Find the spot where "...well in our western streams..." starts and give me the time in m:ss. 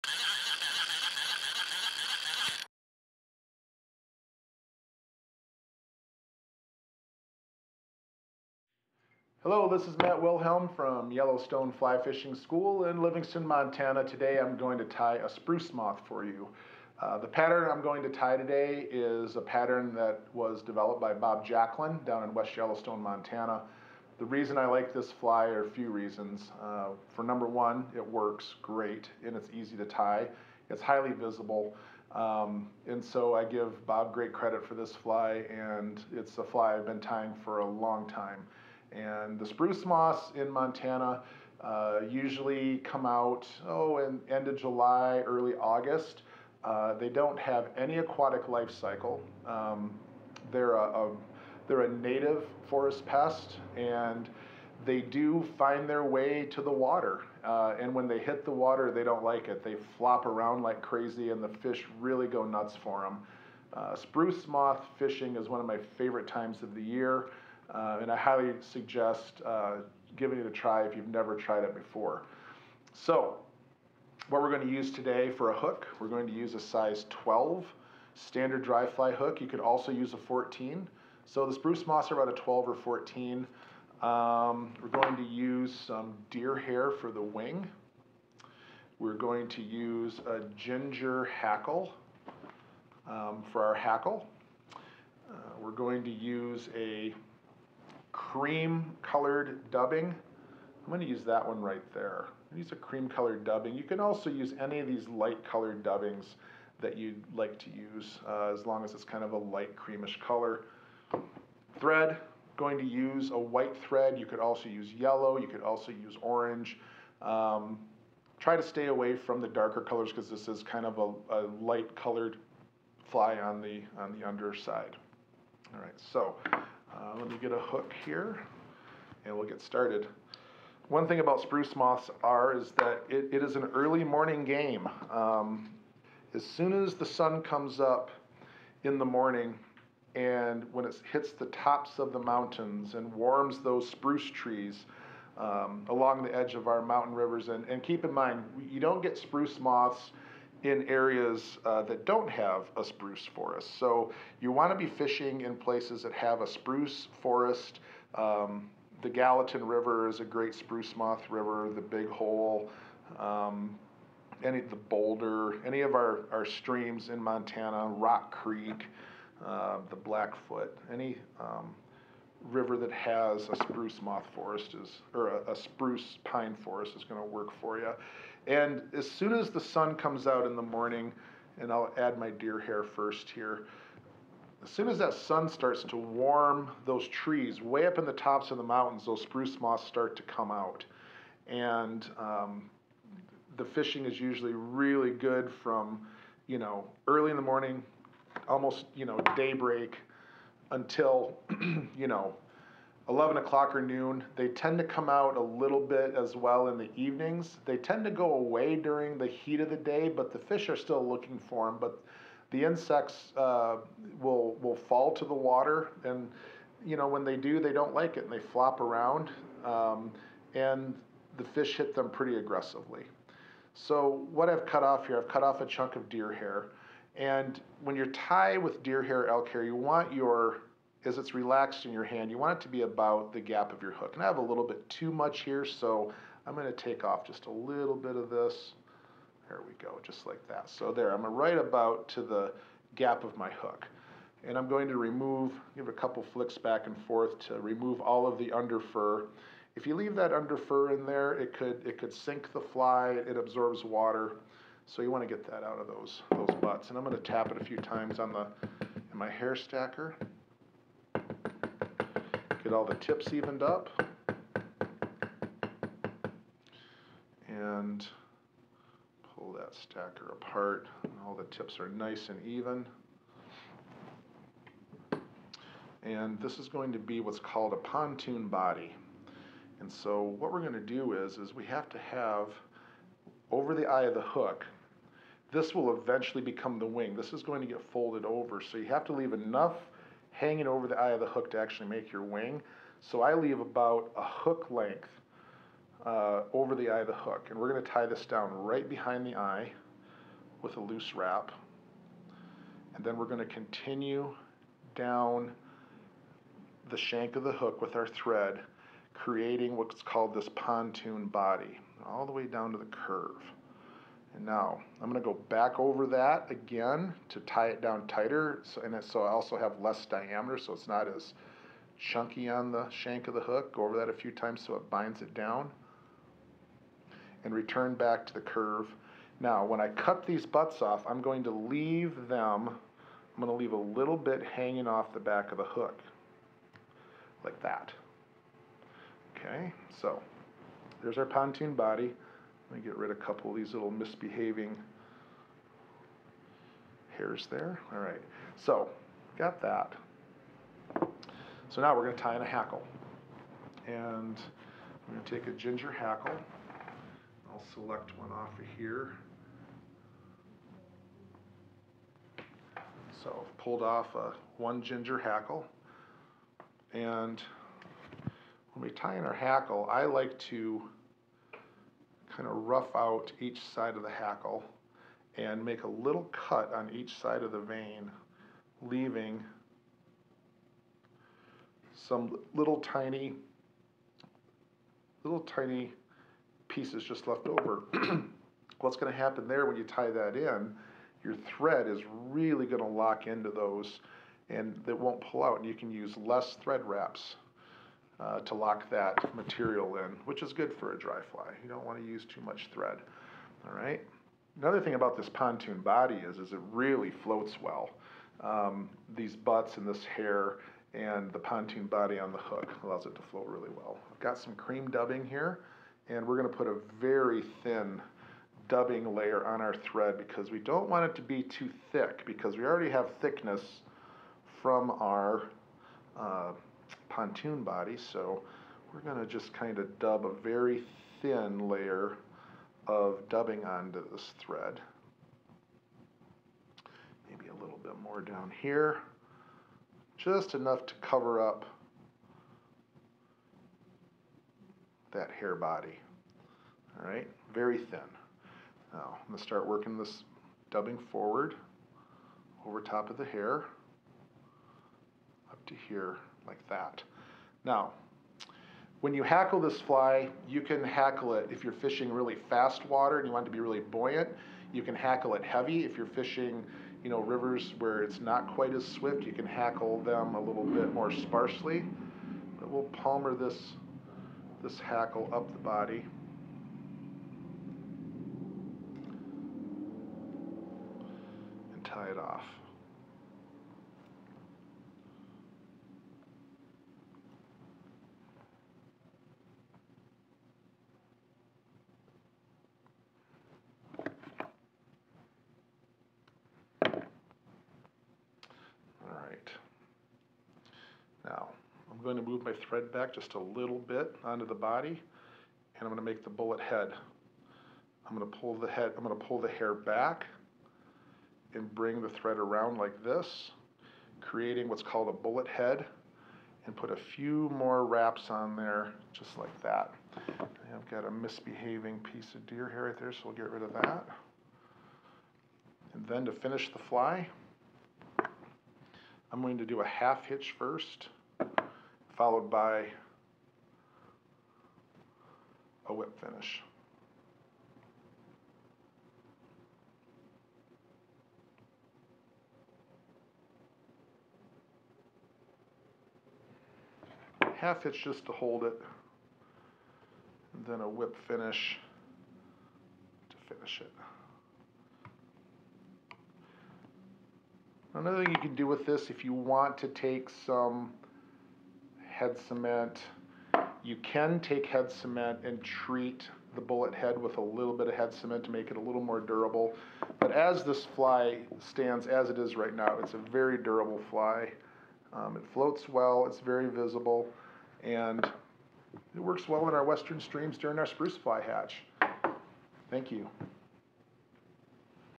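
9:39.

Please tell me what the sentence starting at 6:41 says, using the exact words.
You don't want to use too much thread.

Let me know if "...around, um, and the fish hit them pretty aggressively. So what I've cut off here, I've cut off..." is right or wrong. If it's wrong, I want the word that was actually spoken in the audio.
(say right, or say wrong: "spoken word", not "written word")
right.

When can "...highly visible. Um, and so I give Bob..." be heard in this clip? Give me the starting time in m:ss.
0:30.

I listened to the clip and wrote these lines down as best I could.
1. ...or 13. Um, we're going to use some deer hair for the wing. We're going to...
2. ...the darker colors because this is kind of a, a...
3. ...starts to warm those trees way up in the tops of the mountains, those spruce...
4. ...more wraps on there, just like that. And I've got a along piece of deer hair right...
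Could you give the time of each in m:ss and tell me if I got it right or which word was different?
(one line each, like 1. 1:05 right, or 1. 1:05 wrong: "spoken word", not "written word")
1. 1:22 wrong: "14", not "13"
2. 1:59 right
3. 3:05 right
4. 8:37 wrong: "misbehaving", not "along".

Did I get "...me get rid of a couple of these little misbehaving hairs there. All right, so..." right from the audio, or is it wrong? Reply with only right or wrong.
right.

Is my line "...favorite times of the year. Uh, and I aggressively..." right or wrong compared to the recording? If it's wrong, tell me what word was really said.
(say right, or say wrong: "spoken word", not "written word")
wrong: "highly", not "aggressively".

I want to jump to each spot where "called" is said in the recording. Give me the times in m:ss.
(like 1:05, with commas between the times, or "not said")
4:37, 5:10, 8:34.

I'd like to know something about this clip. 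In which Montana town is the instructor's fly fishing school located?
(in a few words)
Livingston.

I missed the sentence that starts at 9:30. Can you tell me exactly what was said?
But as this fly stands as it is right now, it's a very durable fly.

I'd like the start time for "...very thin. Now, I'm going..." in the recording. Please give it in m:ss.
7:27.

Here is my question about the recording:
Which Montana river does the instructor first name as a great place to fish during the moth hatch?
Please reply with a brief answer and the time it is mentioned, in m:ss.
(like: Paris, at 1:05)
Gallatin River, at 2:39.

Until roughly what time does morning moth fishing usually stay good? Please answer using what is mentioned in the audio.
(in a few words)
Noon.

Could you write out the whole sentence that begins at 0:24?
The reason I like this fly are a few reasons.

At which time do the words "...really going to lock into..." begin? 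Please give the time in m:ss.
6:32.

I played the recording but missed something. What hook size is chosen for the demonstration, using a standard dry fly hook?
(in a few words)
12.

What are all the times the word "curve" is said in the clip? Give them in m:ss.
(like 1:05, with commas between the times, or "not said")
5:12, 5:28.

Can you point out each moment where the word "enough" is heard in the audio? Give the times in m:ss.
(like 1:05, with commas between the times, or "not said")
4:49, 7:20.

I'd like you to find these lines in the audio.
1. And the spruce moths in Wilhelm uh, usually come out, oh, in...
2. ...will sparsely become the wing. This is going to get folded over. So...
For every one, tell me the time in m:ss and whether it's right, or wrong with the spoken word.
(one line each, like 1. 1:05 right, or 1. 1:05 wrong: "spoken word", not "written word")
1. 0:38 wrong: "Montana", not "Wilhelm"
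2. 4:45 wrong: "eventually", not "sparsely".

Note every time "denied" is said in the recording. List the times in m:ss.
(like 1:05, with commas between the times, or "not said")
not said.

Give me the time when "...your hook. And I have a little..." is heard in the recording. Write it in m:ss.
3:53.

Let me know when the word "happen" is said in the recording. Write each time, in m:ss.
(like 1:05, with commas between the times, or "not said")
6:29.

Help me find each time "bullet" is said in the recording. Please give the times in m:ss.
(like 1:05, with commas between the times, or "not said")
8:26, 8:35, 9:26.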